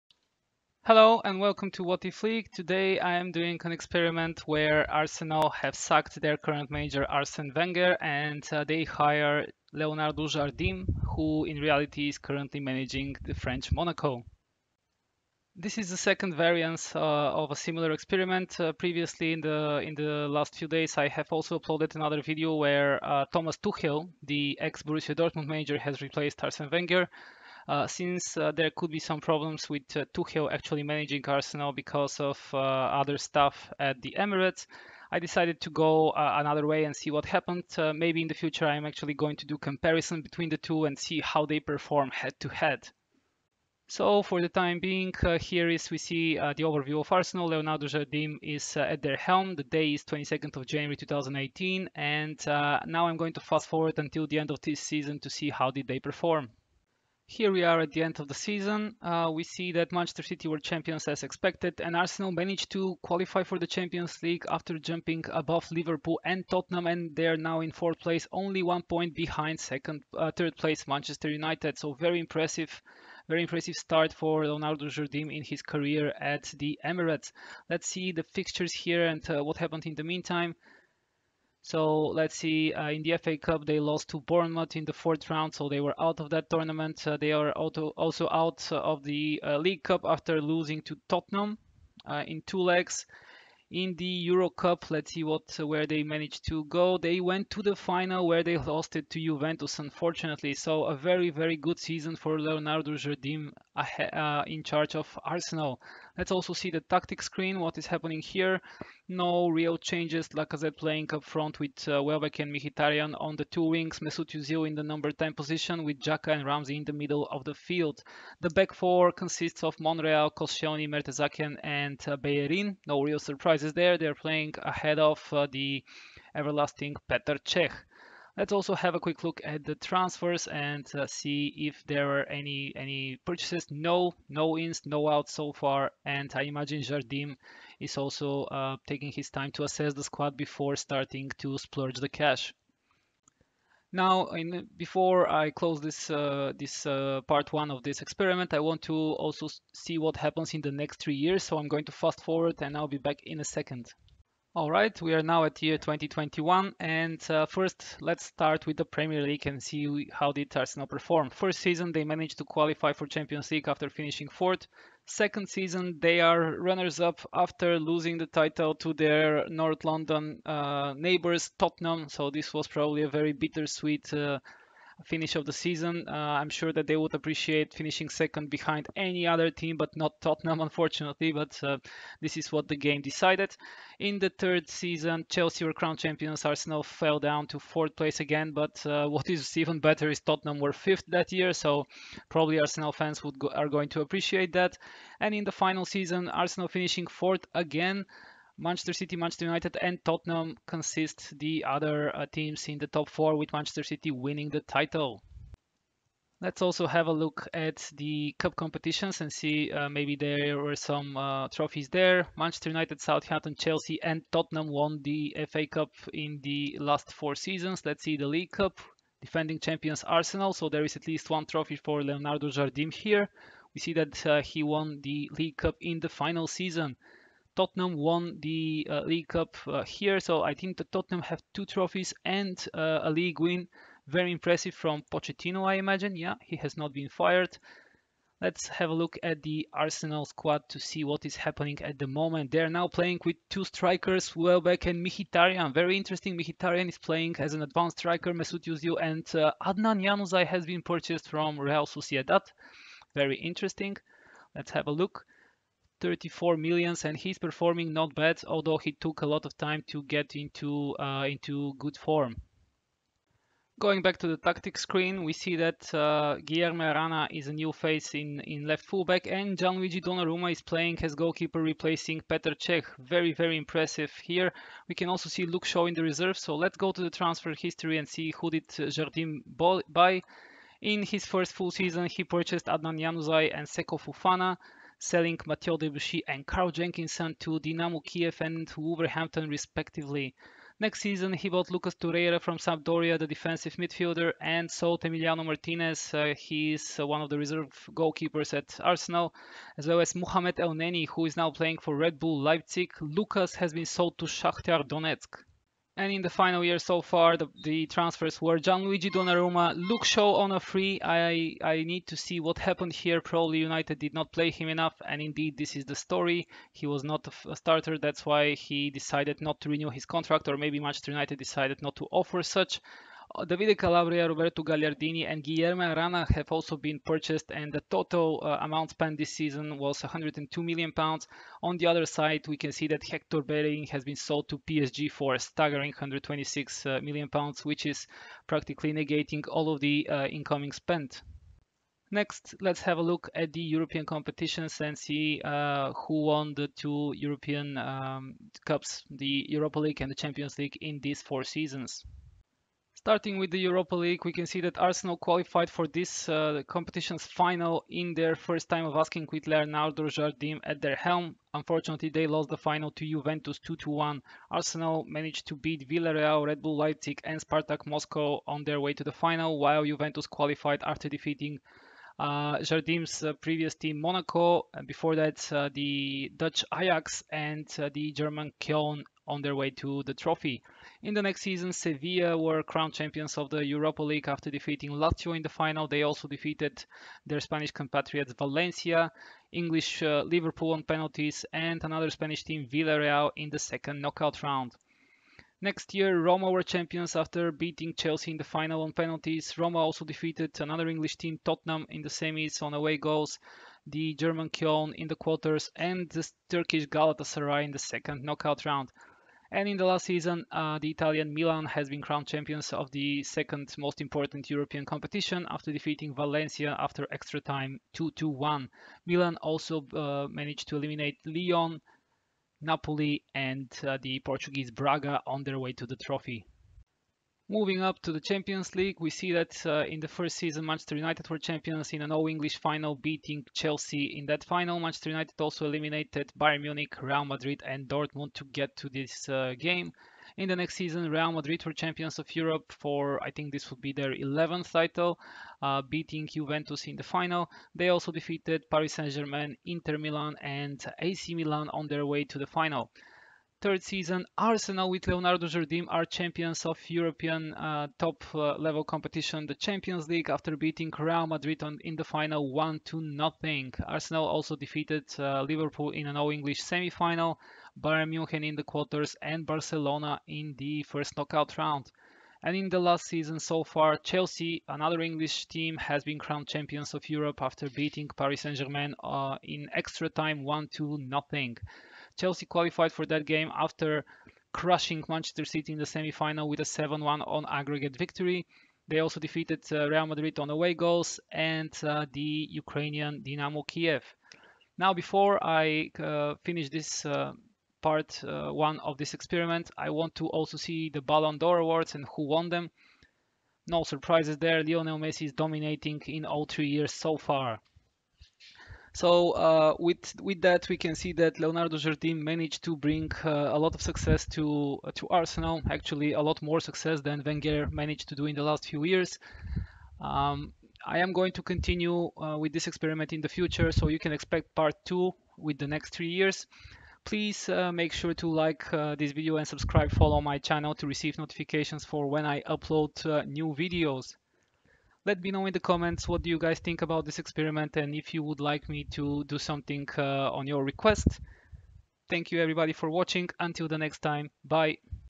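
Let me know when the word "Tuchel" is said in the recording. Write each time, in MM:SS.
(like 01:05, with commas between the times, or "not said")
00:23, 00:30.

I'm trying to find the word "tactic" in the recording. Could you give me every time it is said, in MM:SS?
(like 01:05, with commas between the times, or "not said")
01:46, 04:24.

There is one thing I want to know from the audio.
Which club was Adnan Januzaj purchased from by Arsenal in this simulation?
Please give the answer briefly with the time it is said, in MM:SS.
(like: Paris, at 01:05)
Real Sociedad, at 04:11.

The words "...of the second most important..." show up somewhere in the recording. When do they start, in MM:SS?
06:52.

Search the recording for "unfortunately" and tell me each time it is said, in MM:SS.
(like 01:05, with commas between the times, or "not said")
01:39, 03:00, 06:01.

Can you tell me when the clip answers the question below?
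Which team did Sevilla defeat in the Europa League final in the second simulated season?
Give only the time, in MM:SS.
06:24.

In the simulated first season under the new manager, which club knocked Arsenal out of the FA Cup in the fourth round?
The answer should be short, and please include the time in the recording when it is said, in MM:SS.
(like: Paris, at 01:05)
Bournemouth, at 01:24.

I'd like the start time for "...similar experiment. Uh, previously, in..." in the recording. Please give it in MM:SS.
00:17.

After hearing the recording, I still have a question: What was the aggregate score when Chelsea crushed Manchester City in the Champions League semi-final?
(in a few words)
7-1.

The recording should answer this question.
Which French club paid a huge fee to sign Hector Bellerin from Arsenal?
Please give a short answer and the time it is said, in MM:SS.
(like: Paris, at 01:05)
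PSG, at 05:34.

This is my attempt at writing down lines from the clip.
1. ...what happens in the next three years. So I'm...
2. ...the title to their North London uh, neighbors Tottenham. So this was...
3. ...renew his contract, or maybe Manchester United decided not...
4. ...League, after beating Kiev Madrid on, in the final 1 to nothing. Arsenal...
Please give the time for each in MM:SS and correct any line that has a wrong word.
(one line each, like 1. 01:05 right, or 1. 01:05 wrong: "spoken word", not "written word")
1. 02:29 right
2. 02:48 right
3. 05:19 right
4. 07:40 wrong: "Real", not "Kiev".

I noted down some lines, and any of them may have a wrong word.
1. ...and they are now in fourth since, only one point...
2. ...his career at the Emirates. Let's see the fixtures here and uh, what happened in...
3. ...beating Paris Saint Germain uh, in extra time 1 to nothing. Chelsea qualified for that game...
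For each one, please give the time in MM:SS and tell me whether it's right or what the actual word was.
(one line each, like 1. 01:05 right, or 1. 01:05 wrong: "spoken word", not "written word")
1. 01:06 wrong: "place", not "since"
2. 01:15 right
3. 07:57 right.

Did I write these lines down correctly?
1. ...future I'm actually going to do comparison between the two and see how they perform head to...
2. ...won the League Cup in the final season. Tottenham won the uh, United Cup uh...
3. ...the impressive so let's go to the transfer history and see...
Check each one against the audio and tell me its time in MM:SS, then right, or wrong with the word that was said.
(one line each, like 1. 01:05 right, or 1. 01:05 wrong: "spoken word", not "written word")
1. 00:38 right
2. 03:44 wrong: "League", not "United"
3. 04:35 wrong: "reserve", not "impressive".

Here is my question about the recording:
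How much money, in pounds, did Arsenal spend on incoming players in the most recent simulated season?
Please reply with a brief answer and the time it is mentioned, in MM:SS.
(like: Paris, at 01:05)
£102 million, at 05:30.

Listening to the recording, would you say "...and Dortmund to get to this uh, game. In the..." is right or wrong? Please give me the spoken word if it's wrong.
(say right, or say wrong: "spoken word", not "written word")
right.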